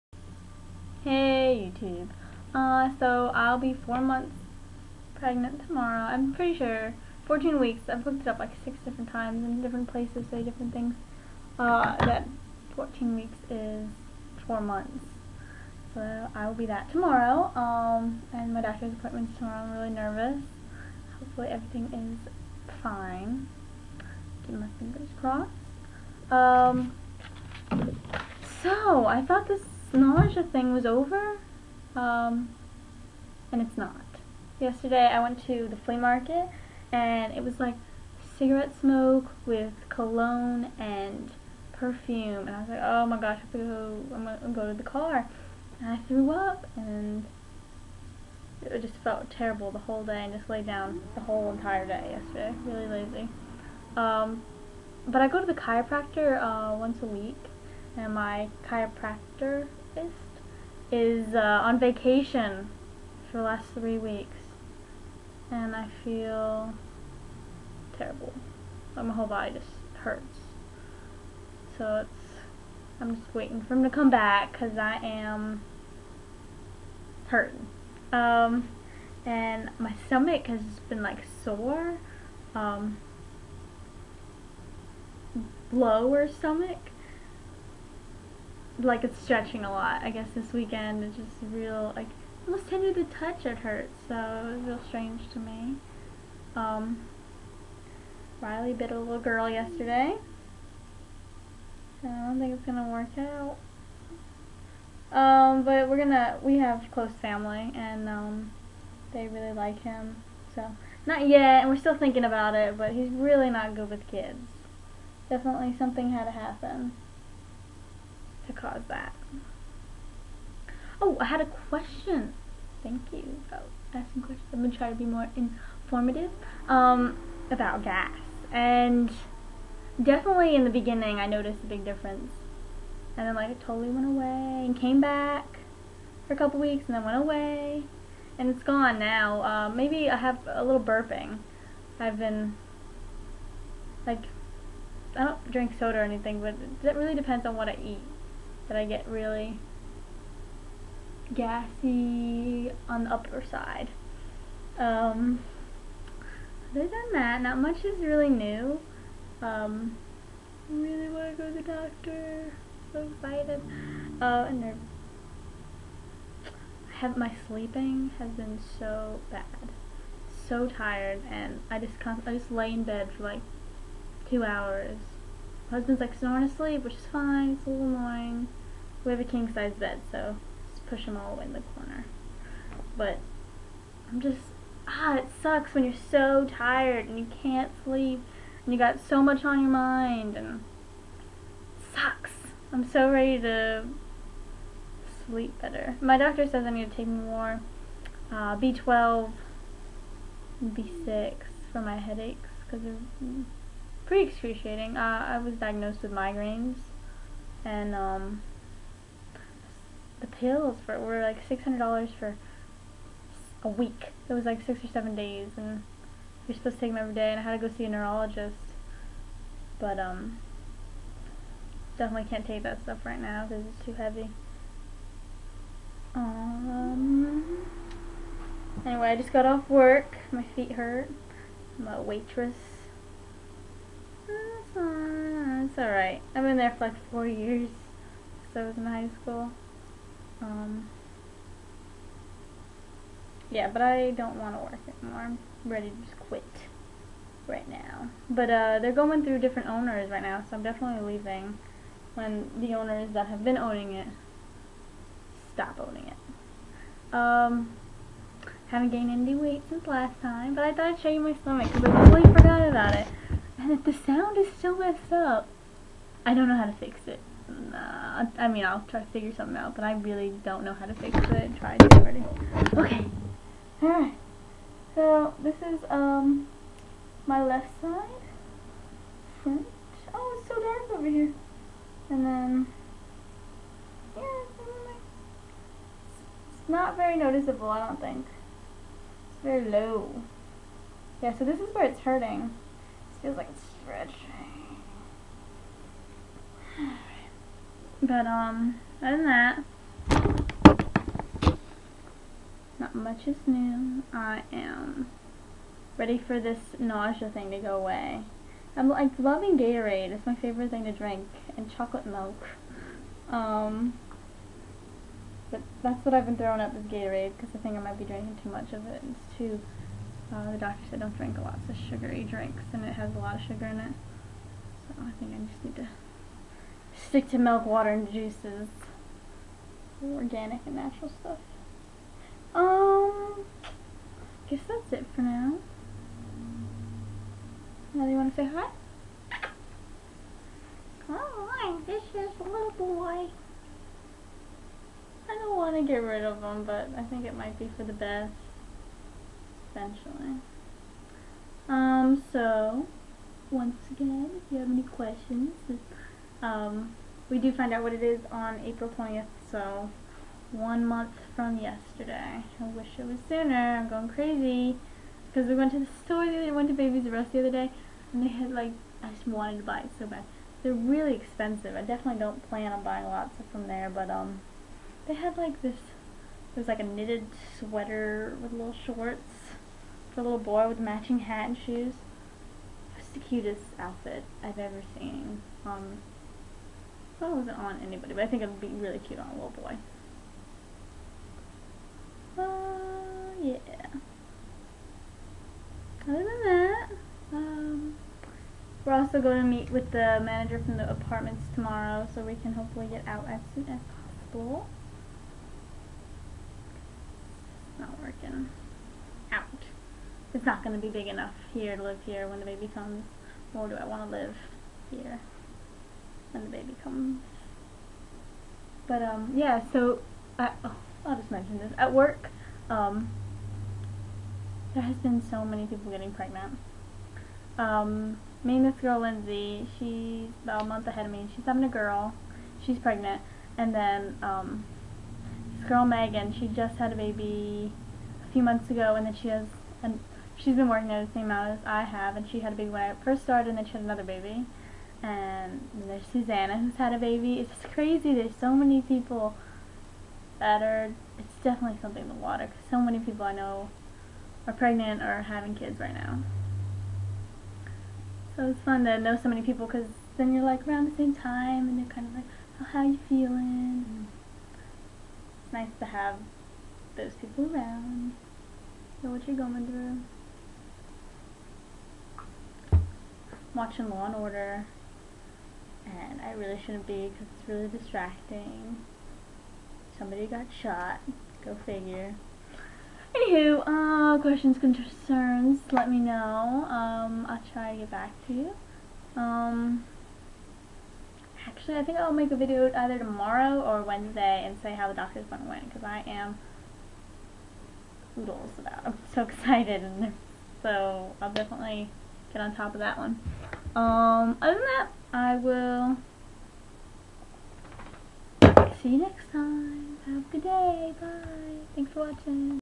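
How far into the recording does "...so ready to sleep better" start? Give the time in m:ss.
3:12.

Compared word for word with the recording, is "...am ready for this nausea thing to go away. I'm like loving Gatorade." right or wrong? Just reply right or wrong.
right.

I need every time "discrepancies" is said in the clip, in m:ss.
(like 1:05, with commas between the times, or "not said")
not said.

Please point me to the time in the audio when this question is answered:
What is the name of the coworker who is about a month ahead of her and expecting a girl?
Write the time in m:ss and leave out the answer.
7:09.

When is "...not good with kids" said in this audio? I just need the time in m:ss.
1:53.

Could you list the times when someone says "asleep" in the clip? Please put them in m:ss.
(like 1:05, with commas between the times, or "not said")
2:56.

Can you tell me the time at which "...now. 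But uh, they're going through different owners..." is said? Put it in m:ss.
4:07.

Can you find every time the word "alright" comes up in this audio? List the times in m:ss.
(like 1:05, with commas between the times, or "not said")
3:55, 4:33.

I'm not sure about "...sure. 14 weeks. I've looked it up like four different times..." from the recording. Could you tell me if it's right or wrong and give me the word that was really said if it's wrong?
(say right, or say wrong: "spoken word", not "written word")
wrong: "six", not "four".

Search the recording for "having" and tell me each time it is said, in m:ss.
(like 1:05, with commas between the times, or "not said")
7:11, 7:35.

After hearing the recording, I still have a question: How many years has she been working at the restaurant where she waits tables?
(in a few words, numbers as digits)
4.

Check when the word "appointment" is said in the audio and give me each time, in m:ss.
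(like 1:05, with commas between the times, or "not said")
0:18, 8:15.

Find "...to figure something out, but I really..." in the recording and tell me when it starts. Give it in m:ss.
4:29.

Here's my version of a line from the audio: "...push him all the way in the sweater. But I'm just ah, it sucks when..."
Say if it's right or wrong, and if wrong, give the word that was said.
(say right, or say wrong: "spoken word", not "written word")
wrong: "corner", not "sweater".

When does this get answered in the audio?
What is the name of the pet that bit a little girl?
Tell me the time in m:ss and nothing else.
1:38.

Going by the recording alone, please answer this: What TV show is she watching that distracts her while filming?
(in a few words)
Law and Order.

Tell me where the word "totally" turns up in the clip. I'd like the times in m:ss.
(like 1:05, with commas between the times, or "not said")
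2:13, 4:22.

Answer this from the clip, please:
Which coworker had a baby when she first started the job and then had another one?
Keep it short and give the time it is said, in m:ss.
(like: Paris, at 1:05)
Megan, at 7:15.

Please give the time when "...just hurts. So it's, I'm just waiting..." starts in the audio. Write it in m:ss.
1:09.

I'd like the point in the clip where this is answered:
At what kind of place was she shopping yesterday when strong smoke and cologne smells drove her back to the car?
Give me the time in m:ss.
0:35.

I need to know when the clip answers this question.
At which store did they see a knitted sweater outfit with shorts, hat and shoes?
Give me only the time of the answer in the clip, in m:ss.
6:06.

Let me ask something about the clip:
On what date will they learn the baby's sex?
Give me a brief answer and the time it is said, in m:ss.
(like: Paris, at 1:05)
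April 20th, at 5:58.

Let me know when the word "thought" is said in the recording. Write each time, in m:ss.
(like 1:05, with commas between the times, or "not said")
0:29, 4:20.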